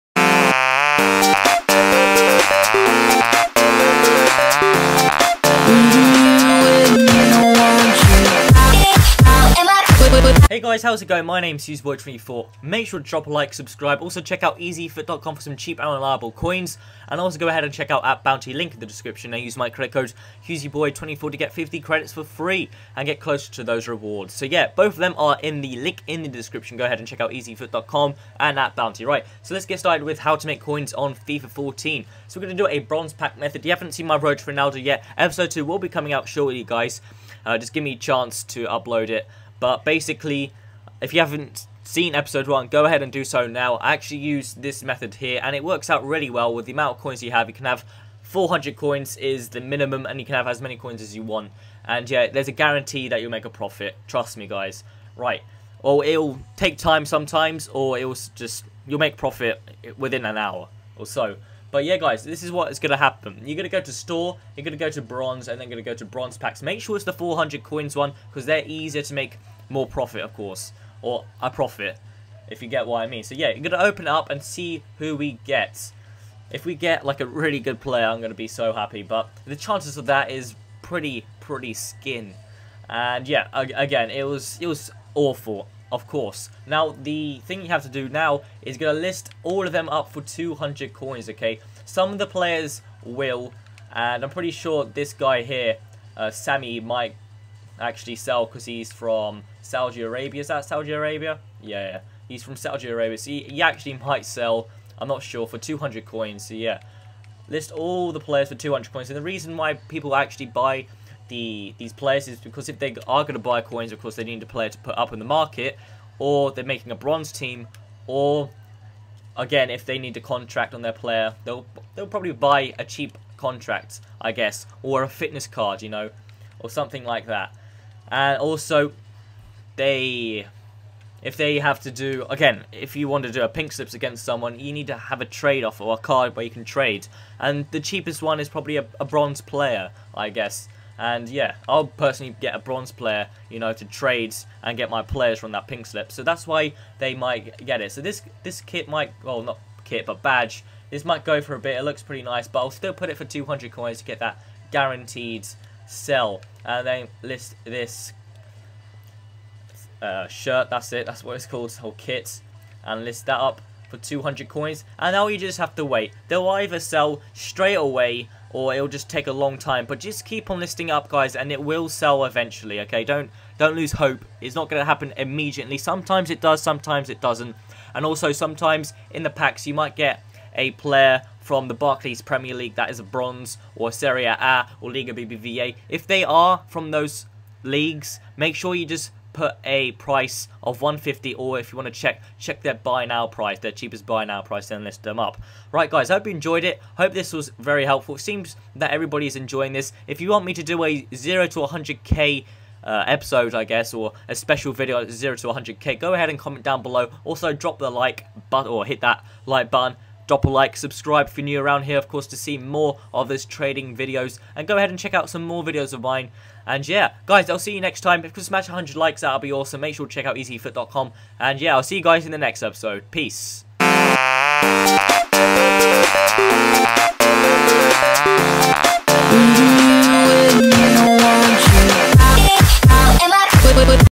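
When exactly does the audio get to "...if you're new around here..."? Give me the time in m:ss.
3:31.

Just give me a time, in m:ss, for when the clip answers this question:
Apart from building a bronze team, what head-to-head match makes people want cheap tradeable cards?
2:13.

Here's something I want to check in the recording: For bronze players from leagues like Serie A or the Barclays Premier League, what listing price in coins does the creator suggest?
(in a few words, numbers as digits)
150.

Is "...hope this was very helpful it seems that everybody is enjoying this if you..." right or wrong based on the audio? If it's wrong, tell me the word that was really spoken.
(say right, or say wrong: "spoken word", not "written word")
right.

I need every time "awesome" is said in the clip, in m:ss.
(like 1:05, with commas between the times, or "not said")
3:39.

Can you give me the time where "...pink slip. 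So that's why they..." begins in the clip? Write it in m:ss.
2:25.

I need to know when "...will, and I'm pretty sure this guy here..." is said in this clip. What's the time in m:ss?
1:33.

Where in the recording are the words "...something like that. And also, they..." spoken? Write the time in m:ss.
2:06.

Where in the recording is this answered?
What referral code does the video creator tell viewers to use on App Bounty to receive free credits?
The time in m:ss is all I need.
0:20.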